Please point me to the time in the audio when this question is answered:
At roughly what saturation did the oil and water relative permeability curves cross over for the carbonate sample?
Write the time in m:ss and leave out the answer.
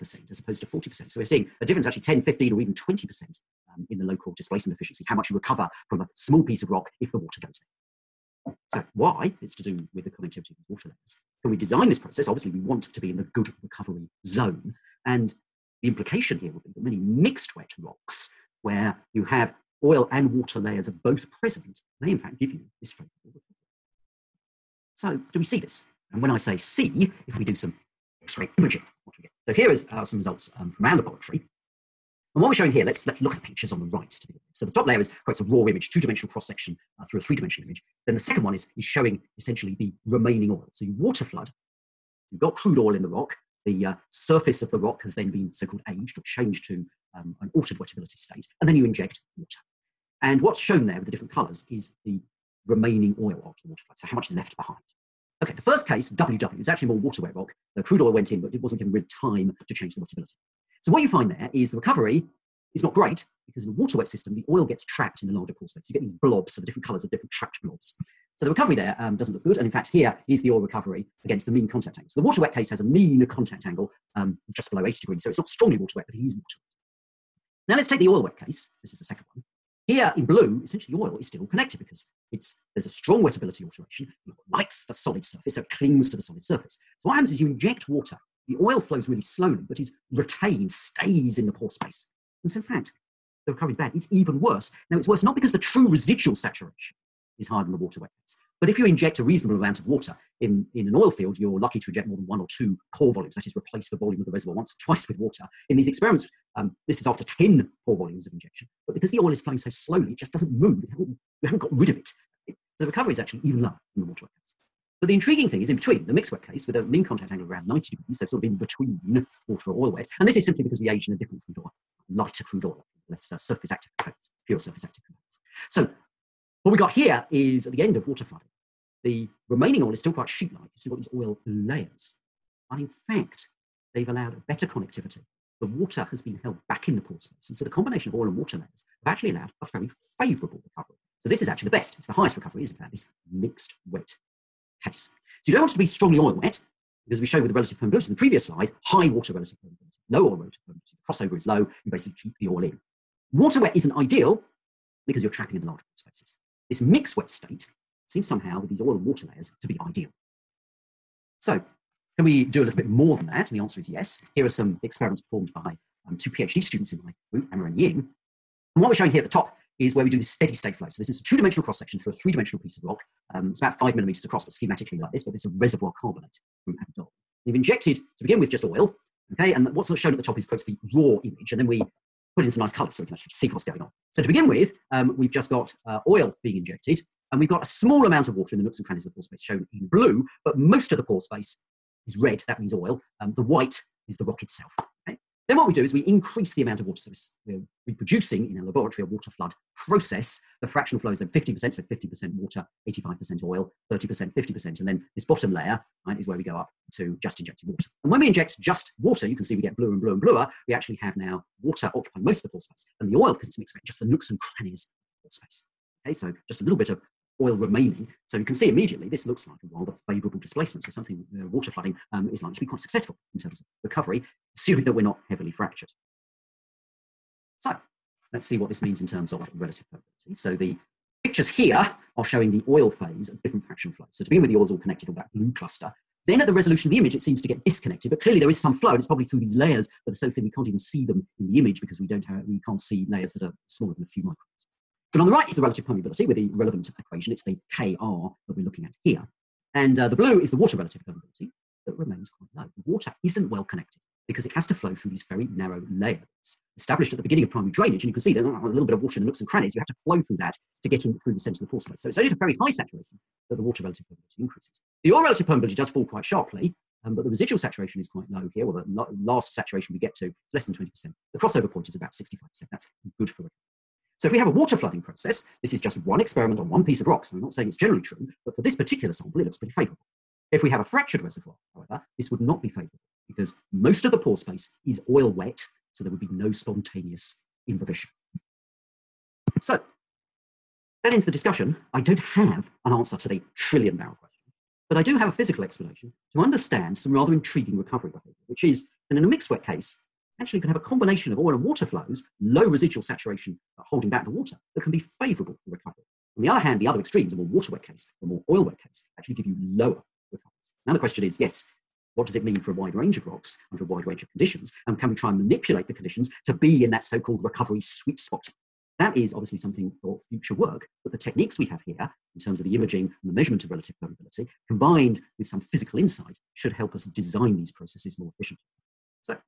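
4:31.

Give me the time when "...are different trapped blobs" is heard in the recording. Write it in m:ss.
1:07.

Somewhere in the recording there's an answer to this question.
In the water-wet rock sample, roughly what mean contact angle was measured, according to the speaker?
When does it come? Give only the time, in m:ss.
1:14.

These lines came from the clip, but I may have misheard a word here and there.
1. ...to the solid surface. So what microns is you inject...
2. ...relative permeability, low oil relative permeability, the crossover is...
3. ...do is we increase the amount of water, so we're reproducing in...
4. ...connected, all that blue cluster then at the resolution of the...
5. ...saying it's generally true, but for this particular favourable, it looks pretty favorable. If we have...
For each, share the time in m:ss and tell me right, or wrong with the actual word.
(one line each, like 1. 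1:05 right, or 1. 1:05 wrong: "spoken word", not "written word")
1. 1:26 wrong: "happens", not "microns"
2. 2:29 right
3. 3:15 right
4. 3:54 right
5. 4:37 wrong: "sample", not "favourable".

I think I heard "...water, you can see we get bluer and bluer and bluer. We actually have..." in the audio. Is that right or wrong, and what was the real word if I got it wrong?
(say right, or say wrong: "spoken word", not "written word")
right.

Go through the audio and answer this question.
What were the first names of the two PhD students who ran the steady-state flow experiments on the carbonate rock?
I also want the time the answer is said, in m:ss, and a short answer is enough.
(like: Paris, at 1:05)
Emma and Ying, at 2:47.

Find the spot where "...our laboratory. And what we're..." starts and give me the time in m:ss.
0:30.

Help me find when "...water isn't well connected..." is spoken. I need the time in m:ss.
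4:12.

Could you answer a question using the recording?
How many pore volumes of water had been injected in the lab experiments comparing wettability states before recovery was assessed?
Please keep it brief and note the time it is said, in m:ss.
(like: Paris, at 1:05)
10, at 1:47.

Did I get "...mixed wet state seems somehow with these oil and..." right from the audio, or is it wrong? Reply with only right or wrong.
right.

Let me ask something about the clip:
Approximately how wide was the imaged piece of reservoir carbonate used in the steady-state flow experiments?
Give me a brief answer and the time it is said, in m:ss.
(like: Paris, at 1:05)
5 millimeters, at 2:53.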